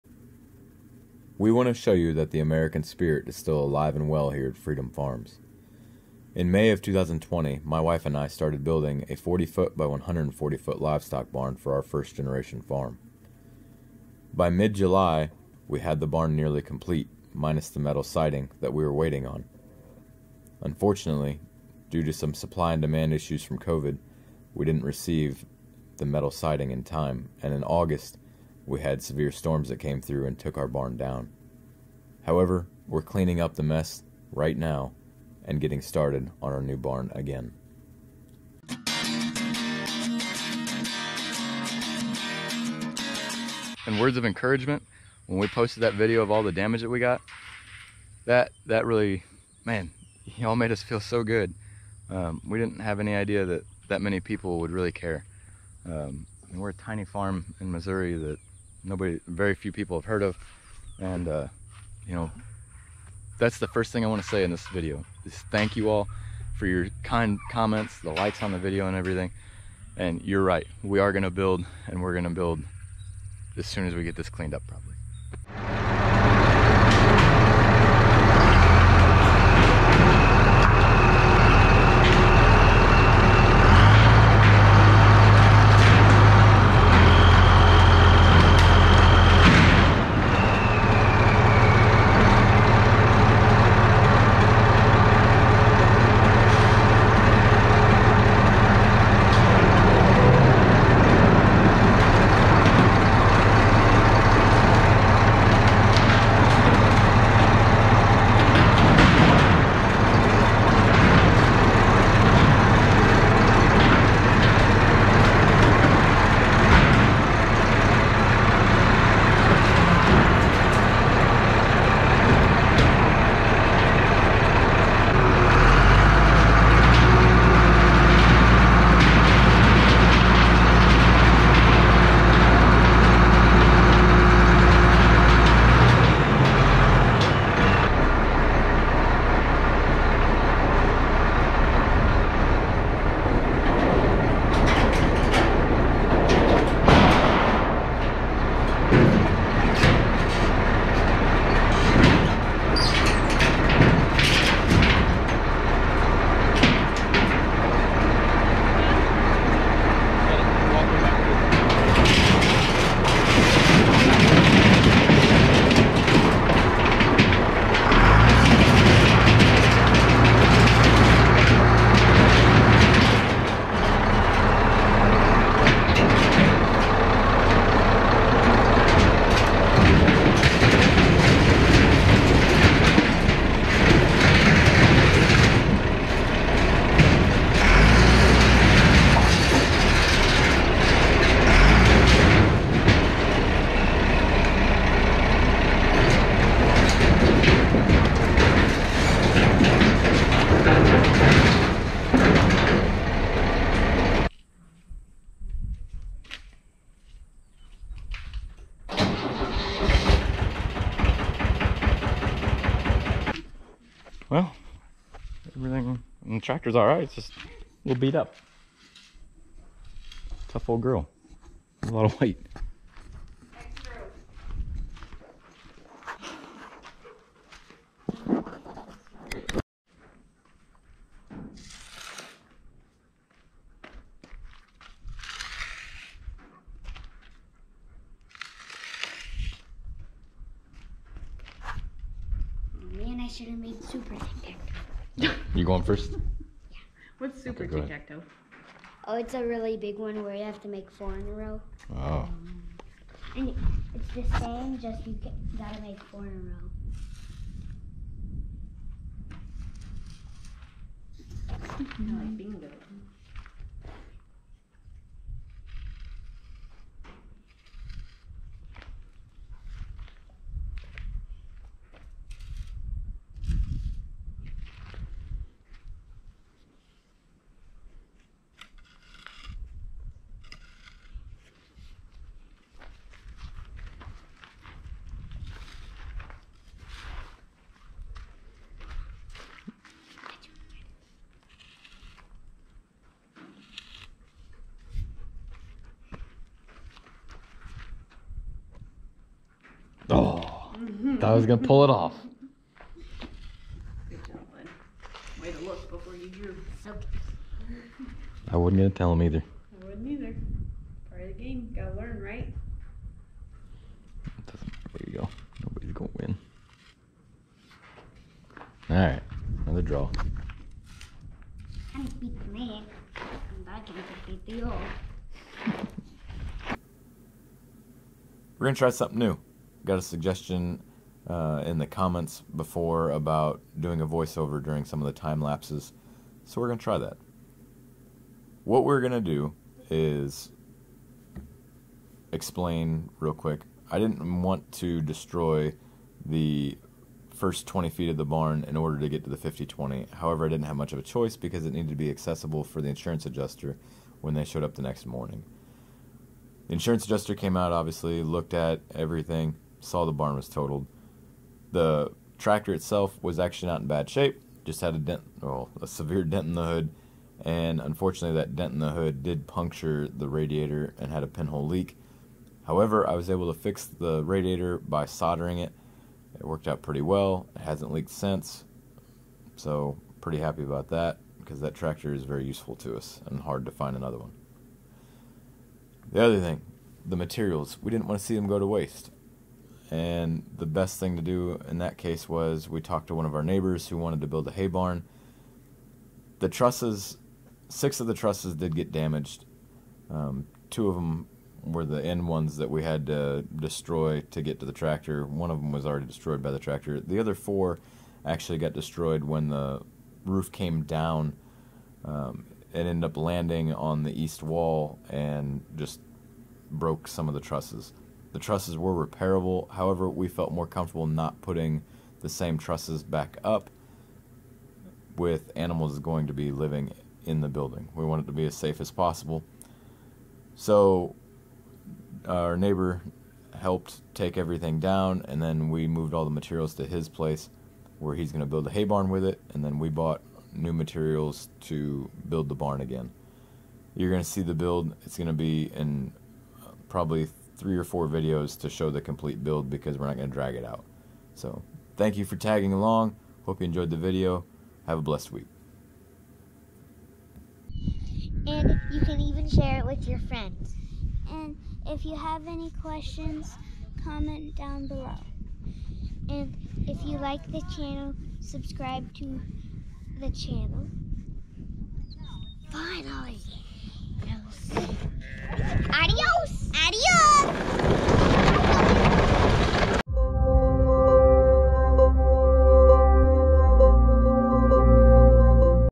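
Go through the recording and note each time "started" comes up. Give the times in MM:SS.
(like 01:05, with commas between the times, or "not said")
00:08, 00:35.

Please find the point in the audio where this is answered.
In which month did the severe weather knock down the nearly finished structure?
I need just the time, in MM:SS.
00:27.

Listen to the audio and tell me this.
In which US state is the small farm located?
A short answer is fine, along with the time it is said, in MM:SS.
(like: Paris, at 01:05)
Missouri, at 00:57.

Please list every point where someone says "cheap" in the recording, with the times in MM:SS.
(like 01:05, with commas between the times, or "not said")
not said.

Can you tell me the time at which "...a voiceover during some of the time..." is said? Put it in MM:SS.
05:34.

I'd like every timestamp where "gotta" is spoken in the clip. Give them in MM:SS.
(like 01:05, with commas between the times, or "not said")
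04:15, 05:11.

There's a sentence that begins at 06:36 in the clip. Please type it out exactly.
The trusses, six of the trusses did get damaged.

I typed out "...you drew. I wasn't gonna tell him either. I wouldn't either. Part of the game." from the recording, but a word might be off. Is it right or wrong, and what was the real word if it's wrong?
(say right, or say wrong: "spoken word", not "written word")
right.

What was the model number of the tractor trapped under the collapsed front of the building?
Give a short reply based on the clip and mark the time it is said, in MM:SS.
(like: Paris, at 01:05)
5020, at 05:49.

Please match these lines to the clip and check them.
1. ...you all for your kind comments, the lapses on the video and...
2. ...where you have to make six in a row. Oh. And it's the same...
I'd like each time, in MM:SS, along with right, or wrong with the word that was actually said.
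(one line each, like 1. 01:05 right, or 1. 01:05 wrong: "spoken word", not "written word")
1. 01:05 wrong: "likes", not "lapses"
2. 04:10 wrong: "four", not "six".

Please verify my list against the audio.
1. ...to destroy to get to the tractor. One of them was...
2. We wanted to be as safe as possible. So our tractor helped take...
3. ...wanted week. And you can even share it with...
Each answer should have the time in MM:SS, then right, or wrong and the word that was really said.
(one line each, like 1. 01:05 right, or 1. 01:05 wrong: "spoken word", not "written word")
1. 06:43 right
2. 07:07 wrong: "neighbor", not "tractor"
3. 07:35 wrong: "blessed", not "wanted".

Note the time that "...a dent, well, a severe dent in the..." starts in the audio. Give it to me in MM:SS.
06:04.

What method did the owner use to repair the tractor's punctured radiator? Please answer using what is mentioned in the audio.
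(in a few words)
Soldering.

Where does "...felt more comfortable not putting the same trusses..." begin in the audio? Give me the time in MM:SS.
07:00.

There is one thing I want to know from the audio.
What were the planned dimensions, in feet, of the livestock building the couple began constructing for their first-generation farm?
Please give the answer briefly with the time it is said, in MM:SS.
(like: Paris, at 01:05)
40 by 140 feet, at 00:09.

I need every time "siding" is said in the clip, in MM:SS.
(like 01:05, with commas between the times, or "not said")
00:18, 00:26.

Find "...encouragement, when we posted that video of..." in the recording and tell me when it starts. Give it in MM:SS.
00:44.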